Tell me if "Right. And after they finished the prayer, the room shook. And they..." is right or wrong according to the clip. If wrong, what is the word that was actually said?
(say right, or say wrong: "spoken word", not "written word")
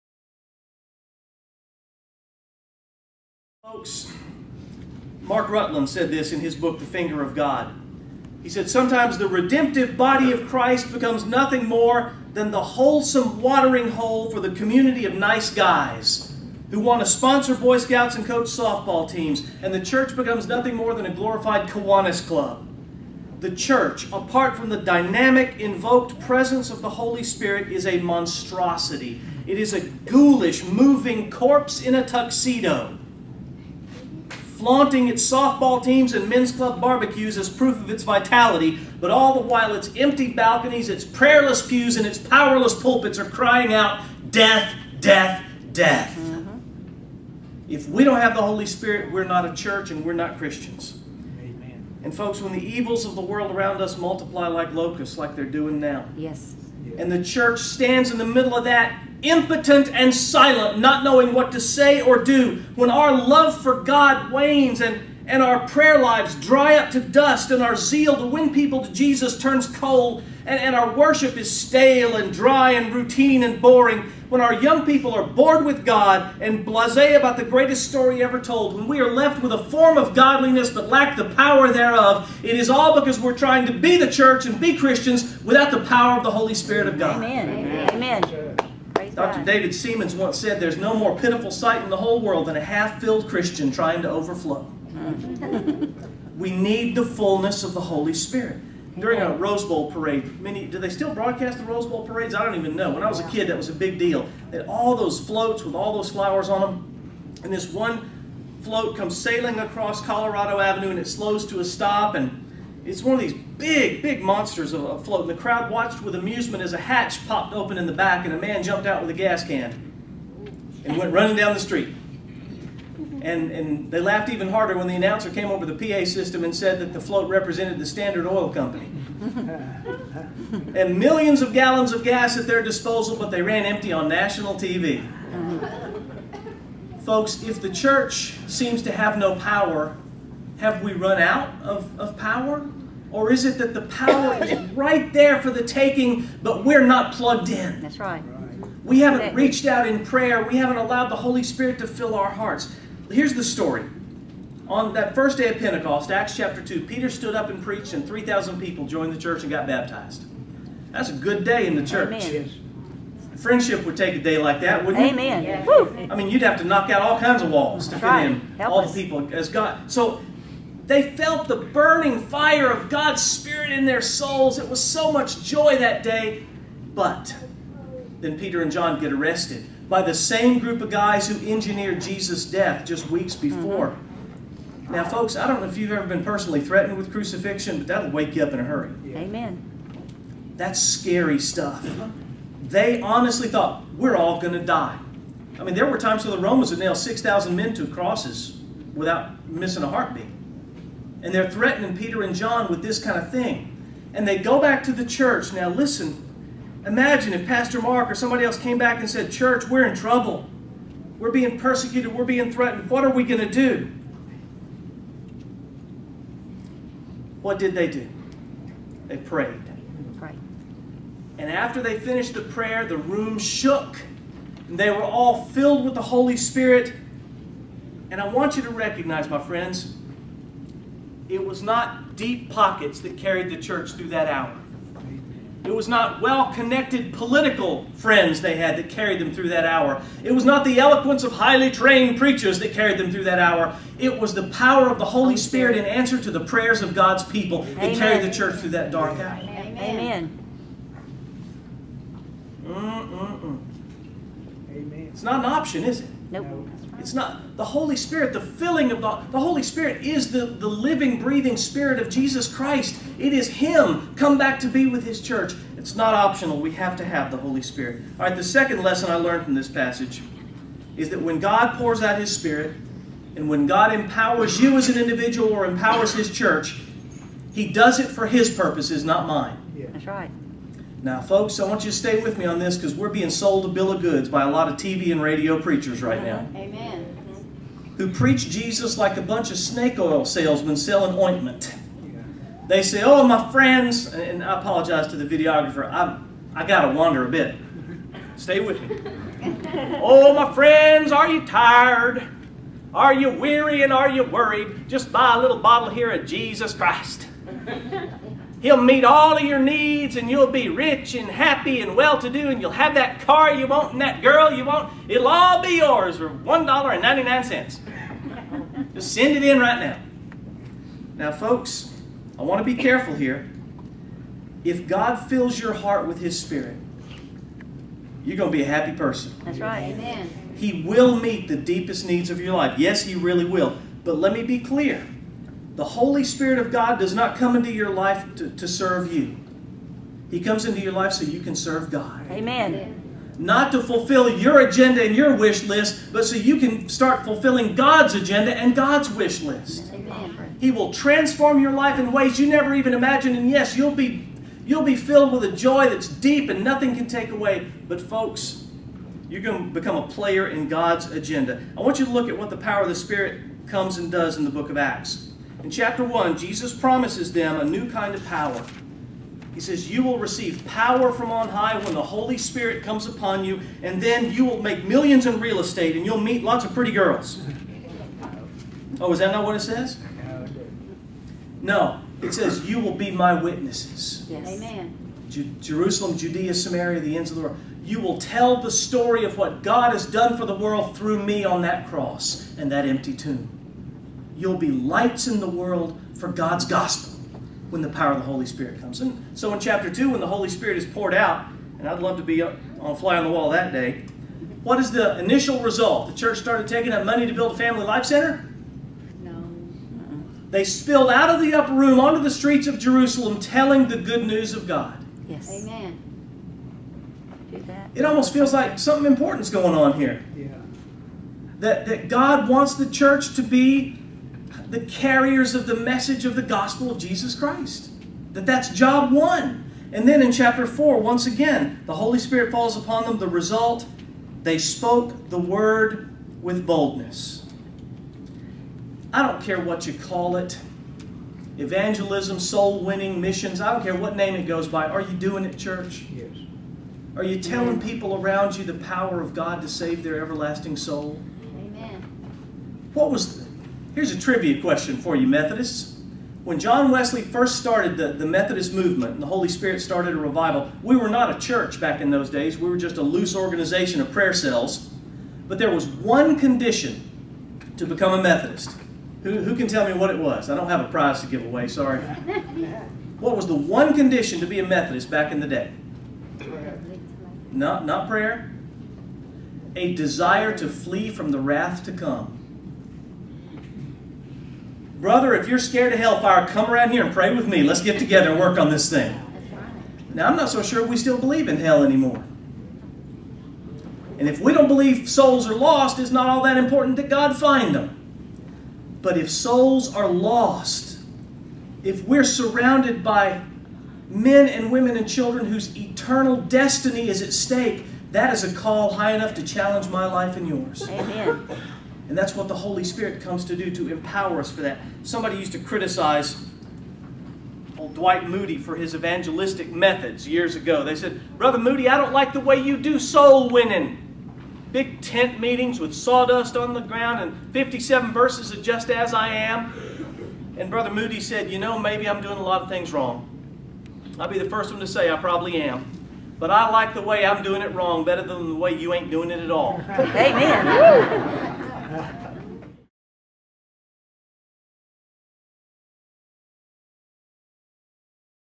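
right.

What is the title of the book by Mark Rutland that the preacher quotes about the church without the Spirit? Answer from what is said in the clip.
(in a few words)
The Finger of God.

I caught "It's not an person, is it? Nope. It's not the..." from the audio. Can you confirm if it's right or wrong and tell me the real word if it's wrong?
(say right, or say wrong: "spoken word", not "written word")
wrong: "option", not "person".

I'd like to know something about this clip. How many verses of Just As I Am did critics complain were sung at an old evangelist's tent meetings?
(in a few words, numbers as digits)
57.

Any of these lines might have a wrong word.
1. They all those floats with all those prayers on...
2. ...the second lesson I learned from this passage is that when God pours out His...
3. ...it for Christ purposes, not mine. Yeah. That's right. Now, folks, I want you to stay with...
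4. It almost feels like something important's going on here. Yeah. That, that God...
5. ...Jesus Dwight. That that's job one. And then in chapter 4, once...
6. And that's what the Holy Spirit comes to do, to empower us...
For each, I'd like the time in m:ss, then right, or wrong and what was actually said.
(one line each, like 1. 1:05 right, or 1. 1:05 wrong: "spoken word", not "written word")
1. 1:44 wrong: "flowers", not "prayers"
2. 4:28 right
3. 4:37 wrong: "His", not "Christ"
4. 6:57 right
5. 7:06 wrong: "Christ", not "Dwight"
6. 8:32 right.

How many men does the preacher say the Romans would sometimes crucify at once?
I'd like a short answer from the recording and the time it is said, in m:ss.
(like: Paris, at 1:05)
6,000, at 3:16.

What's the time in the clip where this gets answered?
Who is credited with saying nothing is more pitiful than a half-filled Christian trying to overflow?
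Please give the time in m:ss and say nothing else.
1:29.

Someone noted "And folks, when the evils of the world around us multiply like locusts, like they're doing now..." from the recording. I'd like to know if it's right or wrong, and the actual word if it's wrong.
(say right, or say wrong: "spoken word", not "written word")
right.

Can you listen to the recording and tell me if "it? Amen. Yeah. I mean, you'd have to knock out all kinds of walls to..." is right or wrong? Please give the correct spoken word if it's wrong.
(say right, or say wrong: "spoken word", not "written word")
right.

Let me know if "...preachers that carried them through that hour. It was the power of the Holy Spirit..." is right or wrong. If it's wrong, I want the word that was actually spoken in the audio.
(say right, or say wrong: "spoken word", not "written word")
right.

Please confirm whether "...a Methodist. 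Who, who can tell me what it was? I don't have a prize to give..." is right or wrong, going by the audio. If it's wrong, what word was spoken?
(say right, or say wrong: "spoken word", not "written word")
right.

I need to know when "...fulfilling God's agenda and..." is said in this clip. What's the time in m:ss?
5:47.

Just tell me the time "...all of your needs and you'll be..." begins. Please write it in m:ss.
5:09.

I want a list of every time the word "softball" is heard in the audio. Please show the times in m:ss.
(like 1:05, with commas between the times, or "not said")
0:18, 0:35.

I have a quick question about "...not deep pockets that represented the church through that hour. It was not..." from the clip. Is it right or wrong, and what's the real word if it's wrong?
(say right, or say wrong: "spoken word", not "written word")
wrong: "carried", not "represented".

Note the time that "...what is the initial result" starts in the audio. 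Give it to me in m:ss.
6:44.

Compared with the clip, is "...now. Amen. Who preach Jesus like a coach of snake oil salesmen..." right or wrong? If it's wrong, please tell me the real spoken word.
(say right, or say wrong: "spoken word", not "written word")
wrong: "bunch", not "coach".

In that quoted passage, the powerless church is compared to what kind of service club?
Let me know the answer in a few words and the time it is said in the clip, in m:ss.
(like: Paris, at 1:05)
Kiwanis club, at 0:21.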